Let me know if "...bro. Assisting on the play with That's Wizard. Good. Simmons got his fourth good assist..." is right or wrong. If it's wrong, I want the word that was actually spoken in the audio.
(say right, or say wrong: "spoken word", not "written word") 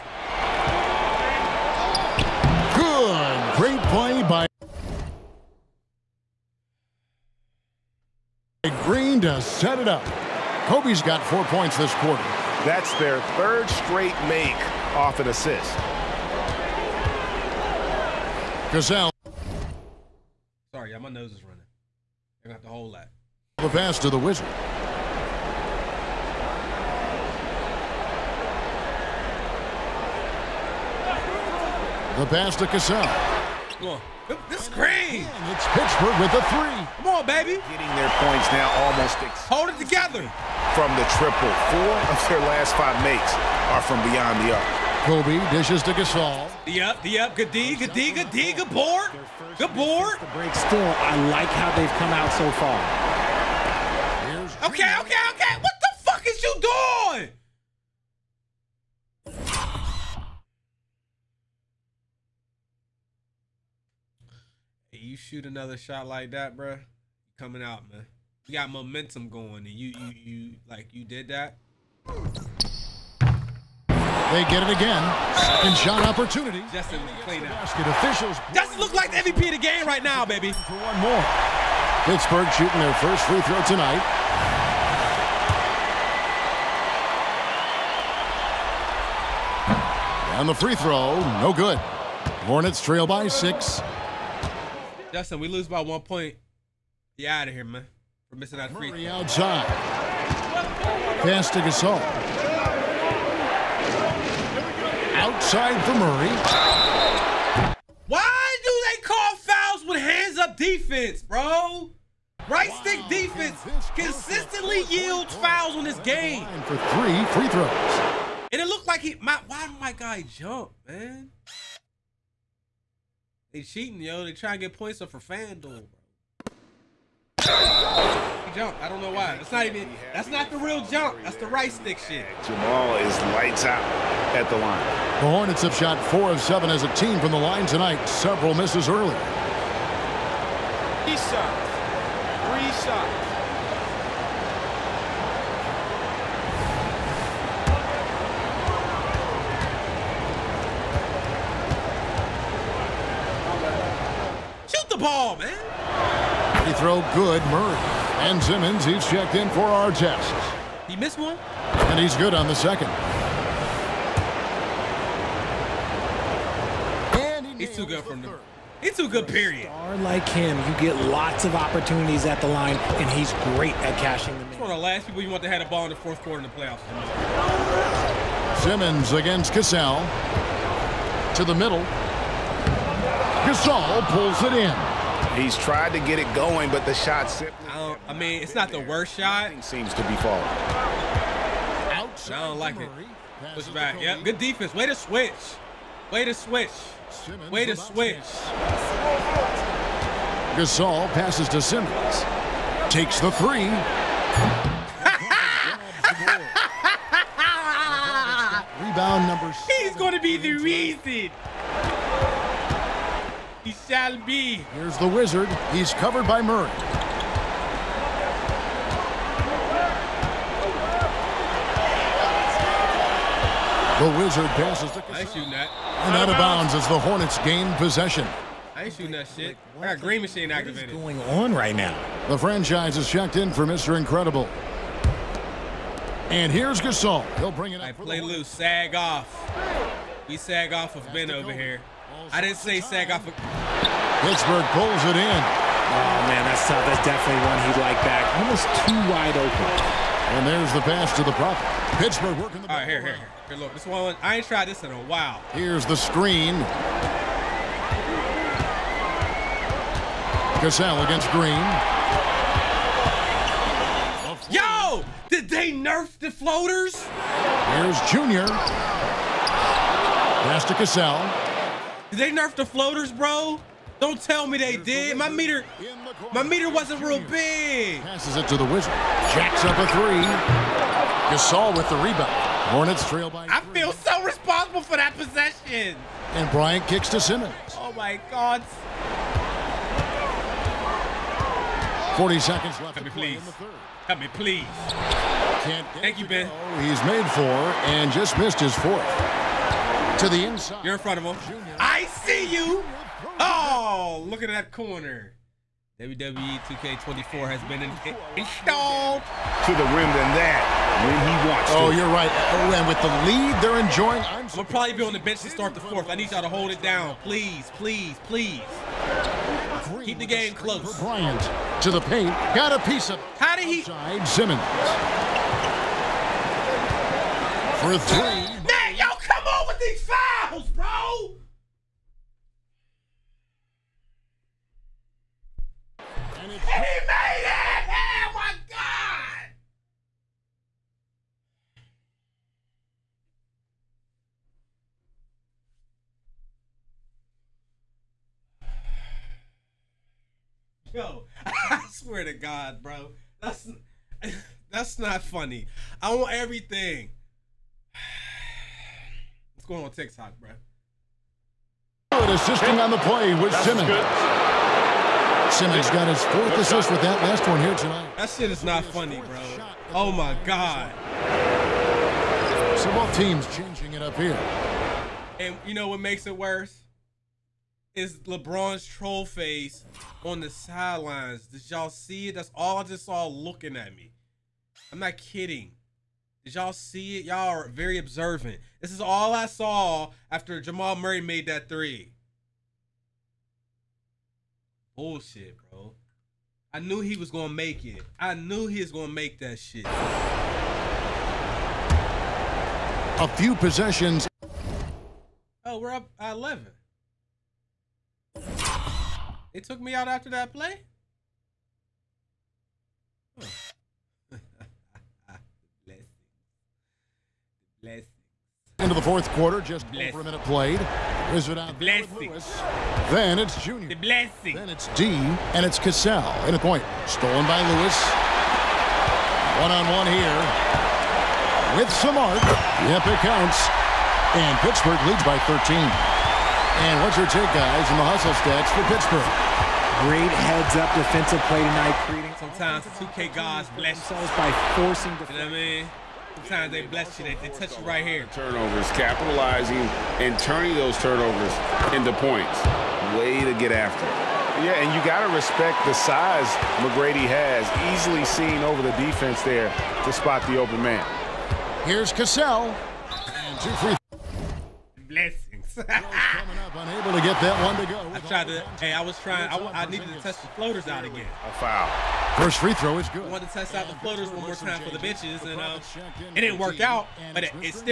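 wrong: "Simmons", not "Wizard".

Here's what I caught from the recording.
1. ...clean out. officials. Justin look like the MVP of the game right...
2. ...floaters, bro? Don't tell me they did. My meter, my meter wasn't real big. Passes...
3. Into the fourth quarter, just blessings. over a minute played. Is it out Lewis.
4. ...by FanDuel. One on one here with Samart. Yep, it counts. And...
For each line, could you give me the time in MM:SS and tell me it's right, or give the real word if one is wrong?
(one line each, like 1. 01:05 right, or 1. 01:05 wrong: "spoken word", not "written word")
1. 01:17 right
2. 04:32 right
3. 06:58 right
4. 07:07 wrong: "Lewis", not "FanDuel".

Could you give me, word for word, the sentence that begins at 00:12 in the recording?
That's their third straight make off an assist.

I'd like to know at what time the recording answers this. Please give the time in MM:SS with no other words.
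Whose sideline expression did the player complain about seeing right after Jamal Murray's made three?
06:18.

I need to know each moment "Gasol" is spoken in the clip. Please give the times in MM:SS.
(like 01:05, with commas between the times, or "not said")
00:18, 00:45, 01:41, 03:03, 03:20, 03:56, 04:41.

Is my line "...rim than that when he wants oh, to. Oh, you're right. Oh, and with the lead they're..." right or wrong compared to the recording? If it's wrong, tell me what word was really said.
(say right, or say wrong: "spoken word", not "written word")
right.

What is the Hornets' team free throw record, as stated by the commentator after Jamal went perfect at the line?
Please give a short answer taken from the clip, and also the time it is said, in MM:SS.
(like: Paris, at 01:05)
4 of 7, at 02:16.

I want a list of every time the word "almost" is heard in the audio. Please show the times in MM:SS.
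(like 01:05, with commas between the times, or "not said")
00:38, 04:08.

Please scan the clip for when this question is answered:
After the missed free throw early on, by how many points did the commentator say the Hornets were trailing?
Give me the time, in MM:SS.
01:32.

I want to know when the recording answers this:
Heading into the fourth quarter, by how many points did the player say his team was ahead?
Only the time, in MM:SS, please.
06:45.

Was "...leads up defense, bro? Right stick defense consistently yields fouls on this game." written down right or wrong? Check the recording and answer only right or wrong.
wrong.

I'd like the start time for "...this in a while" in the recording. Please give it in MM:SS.
04:14.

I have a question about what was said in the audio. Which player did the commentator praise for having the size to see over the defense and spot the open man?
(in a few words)
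McGrady.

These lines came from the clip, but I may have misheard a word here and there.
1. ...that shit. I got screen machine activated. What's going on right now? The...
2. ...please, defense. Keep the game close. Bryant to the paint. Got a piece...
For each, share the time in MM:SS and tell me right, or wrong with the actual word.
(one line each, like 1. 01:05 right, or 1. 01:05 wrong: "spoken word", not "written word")
1. 03:49 wrong: "green", not "screen"
2. 05:17 wrong: "please", not "defense".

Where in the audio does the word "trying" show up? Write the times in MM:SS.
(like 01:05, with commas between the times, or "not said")
02:04, 07:49.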